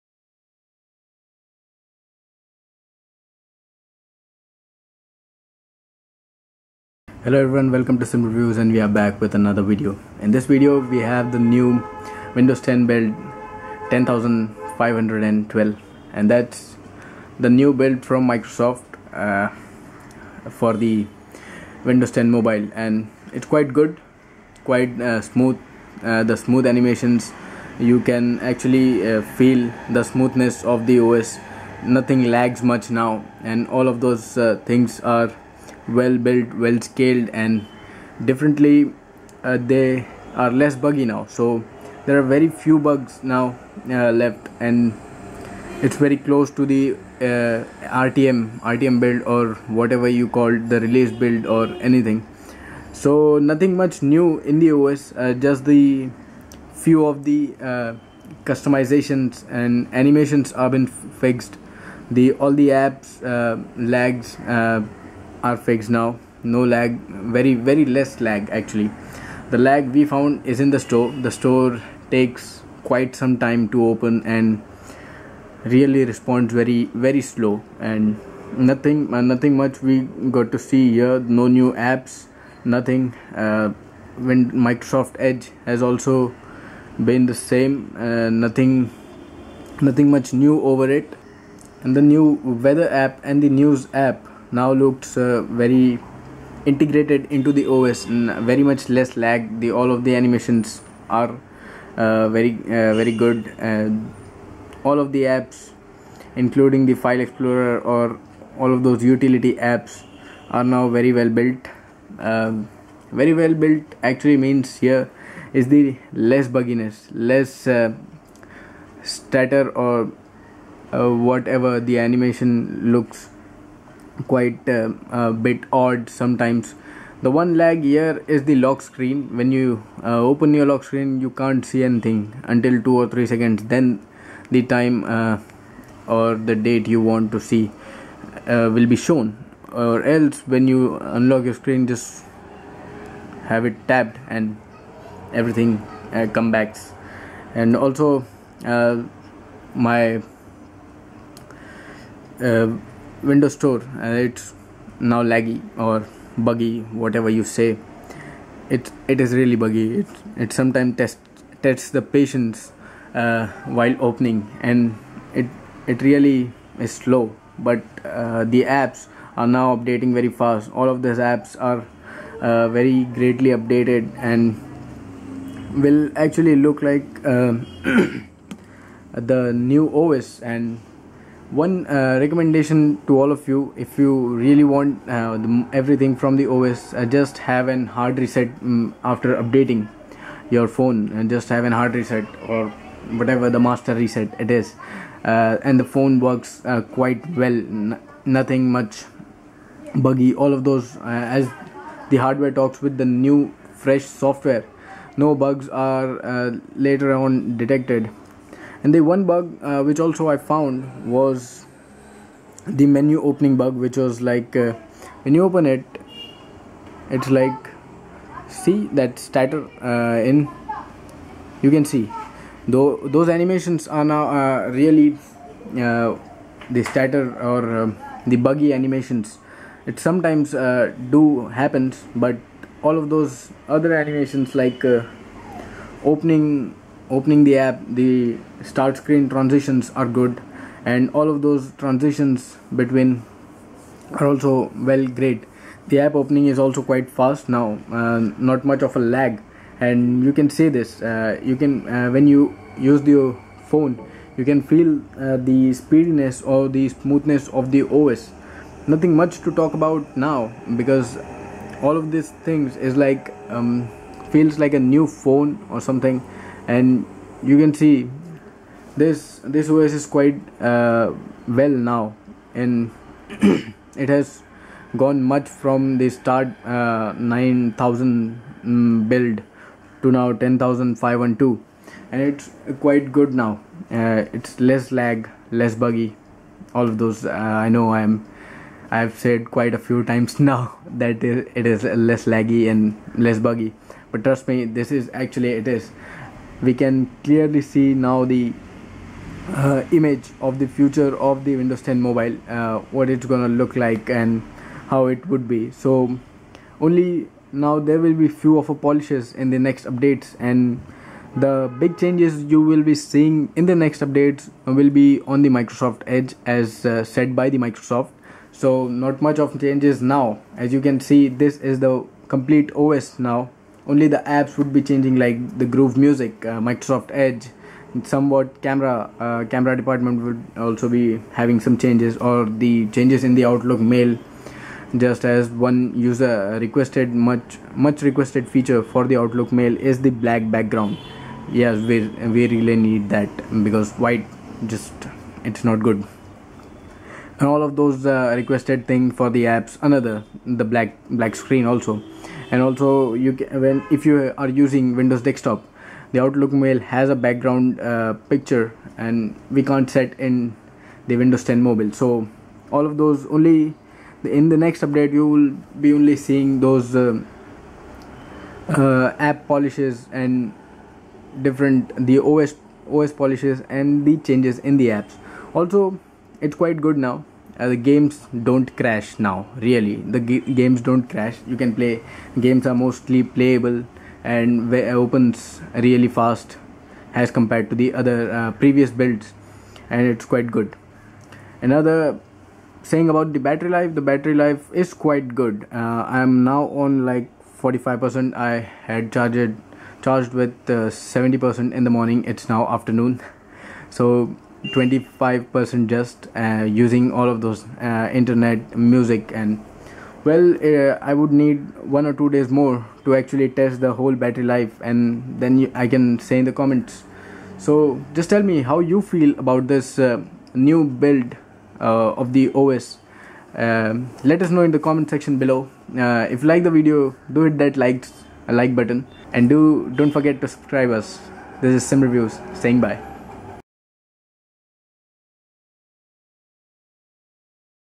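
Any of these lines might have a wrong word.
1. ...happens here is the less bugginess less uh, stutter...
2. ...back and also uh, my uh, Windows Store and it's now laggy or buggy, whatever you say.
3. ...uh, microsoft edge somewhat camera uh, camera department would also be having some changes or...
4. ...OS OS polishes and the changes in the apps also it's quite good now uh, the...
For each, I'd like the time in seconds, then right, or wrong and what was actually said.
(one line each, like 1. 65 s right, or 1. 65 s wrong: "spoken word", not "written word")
1. 114 s wrong: "means", not "happens"
2. 146 s right
3. 326 s right
4. 372 s right.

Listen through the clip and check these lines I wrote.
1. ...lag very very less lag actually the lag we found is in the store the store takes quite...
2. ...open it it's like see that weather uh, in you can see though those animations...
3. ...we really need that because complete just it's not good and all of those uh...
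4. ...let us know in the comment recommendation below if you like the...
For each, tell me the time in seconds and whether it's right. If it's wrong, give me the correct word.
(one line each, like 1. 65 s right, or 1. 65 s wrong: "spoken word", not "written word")
1. 66 s right
2. 215 s wrong: "starter", not "weather"
3. 342 s wrong: "white", not "complete"
4. 424 s wrong: "section", not "recommendation".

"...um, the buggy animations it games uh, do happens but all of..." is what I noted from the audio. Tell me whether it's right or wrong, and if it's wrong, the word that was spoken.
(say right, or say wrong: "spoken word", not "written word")
wrong: "sometimes", not "games".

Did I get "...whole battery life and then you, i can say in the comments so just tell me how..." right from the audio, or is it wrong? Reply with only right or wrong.
right.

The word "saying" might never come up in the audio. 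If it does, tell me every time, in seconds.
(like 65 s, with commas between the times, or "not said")
392 s, 432 s.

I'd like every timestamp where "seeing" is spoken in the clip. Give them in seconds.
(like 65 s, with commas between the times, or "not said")
312 s, 366 s.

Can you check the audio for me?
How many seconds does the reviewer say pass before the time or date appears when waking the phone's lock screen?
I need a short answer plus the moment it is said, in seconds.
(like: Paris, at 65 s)
2 or 3, at 132 s.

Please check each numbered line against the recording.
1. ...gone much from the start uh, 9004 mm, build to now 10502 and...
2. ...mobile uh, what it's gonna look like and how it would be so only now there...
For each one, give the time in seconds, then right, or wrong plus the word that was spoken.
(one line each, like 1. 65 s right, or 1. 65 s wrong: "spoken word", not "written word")
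1. 275 s wrong: "9000", not "9004"
2. 301 s right.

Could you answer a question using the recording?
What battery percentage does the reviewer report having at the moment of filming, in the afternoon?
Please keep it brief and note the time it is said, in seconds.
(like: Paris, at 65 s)
45%, at 397 s.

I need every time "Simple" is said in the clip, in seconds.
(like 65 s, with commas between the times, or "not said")
8 s.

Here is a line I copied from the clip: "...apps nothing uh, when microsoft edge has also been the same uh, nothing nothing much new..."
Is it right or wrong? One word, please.
right.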